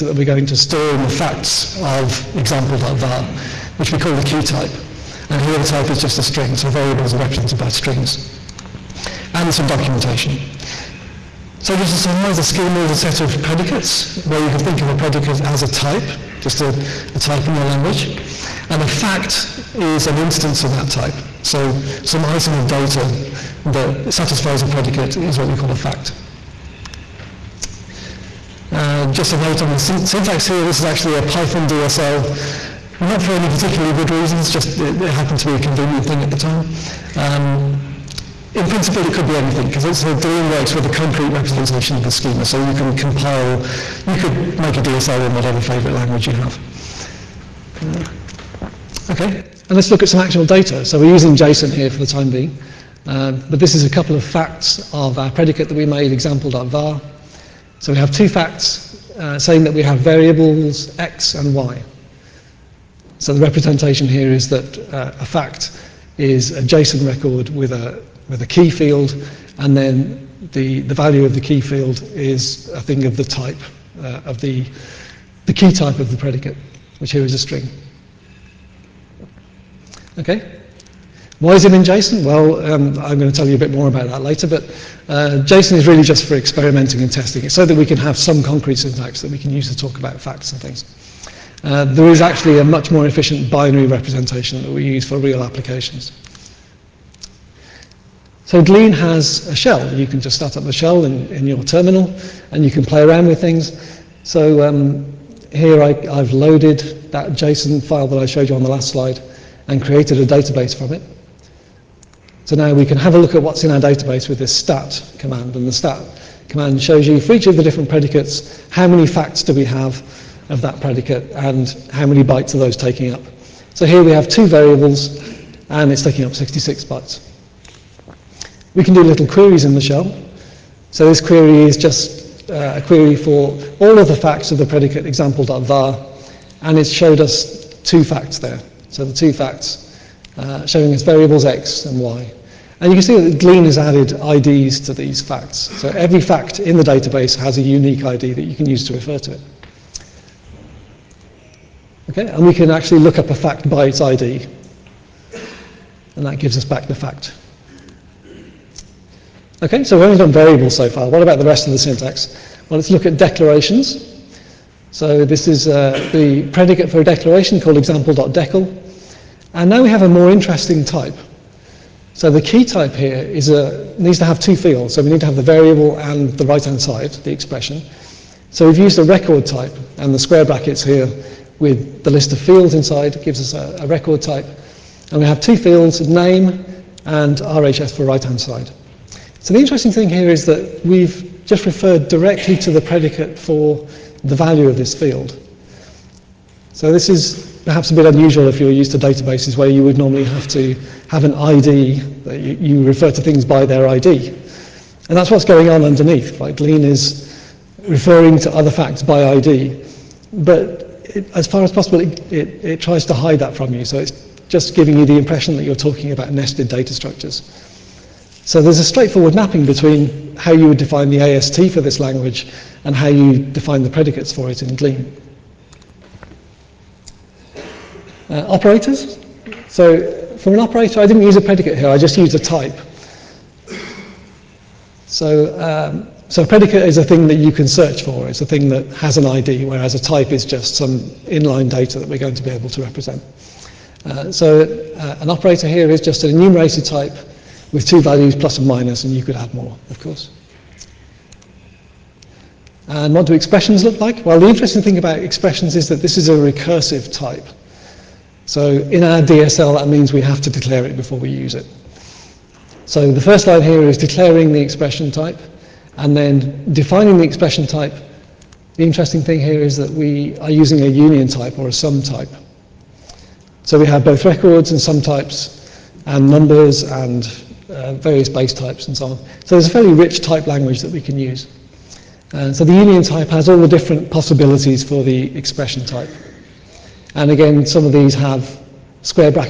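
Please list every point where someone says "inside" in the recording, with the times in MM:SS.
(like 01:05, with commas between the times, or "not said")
03:02.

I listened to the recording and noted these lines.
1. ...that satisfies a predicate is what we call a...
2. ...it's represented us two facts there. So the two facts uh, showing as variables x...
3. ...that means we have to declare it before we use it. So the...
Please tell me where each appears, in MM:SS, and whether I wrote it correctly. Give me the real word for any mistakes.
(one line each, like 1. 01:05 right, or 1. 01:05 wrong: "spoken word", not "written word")
1. 00:23 right
2. 02:16 wrong: "showed", not "represented"
3. 04:19 right.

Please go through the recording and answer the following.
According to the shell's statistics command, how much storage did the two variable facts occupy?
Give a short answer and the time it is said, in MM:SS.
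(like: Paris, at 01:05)
66 bytes, at 02:06.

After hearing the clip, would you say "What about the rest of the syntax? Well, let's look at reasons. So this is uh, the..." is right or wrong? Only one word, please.
wrong.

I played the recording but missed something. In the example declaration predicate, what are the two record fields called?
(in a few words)
name and RHS.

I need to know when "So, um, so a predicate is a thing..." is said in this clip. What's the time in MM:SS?
03:55.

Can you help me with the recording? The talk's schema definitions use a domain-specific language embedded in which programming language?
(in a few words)
Python.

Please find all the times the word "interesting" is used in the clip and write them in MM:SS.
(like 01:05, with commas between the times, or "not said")
02:50, 03:09, 04:14, 04:28.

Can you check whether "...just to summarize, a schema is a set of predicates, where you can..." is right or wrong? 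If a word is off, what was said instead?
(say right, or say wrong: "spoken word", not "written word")
right.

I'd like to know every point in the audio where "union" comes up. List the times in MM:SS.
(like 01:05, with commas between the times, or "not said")
04:30, 04:42.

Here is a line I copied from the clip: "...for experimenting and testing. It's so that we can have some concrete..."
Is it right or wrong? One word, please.
right.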